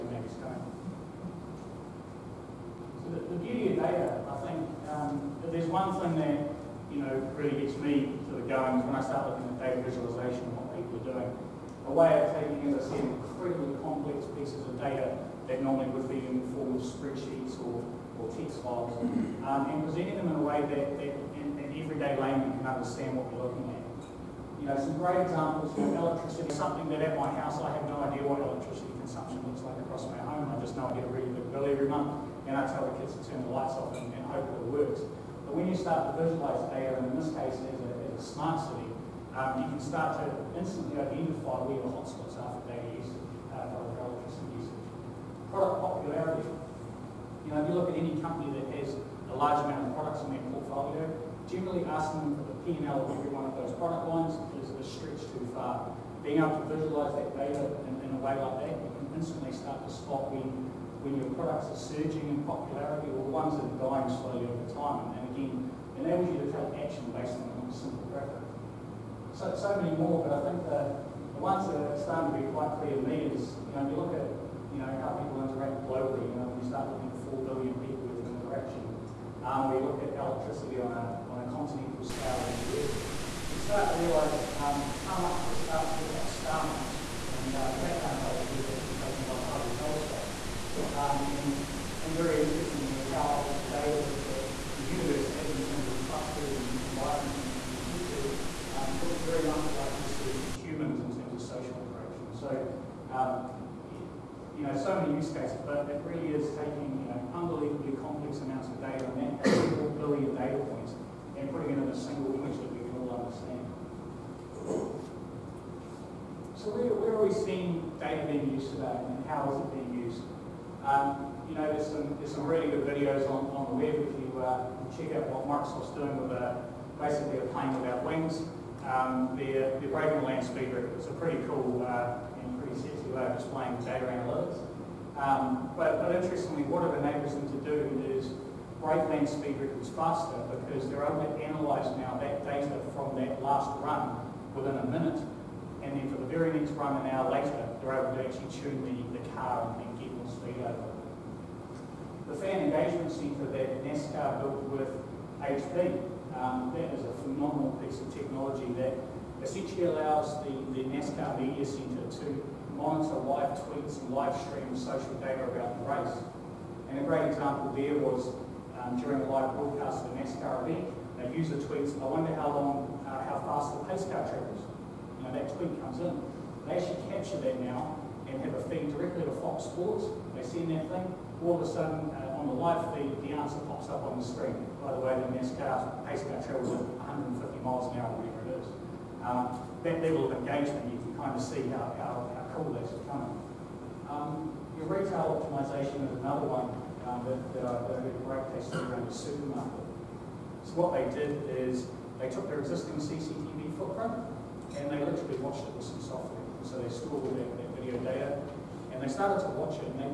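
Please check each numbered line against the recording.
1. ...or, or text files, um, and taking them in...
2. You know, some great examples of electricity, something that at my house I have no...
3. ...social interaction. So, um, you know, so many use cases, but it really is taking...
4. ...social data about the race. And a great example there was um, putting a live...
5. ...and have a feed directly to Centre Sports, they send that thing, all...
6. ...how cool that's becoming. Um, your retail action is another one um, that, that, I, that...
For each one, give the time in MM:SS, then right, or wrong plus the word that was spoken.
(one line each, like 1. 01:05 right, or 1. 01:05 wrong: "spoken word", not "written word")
1. 00:17 wrong: "presenting", not "taking"
2. 00:24 right
3. 01:41 right
4. 02:44 wrong: "during", not "putting"
5. 02:58 wrong: "Fox", not "Centre"
6. 03:12 wrong: "optimization", not "action".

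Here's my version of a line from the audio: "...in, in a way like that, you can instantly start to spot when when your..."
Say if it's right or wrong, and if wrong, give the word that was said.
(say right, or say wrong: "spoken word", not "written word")
right.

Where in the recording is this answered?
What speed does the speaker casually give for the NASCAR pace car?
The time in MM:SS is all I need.
03:07.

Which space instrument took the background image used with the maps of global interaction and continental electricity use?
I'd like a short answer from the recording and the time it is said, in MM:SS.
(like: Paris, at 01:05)
Hubble telescope, at 01:29.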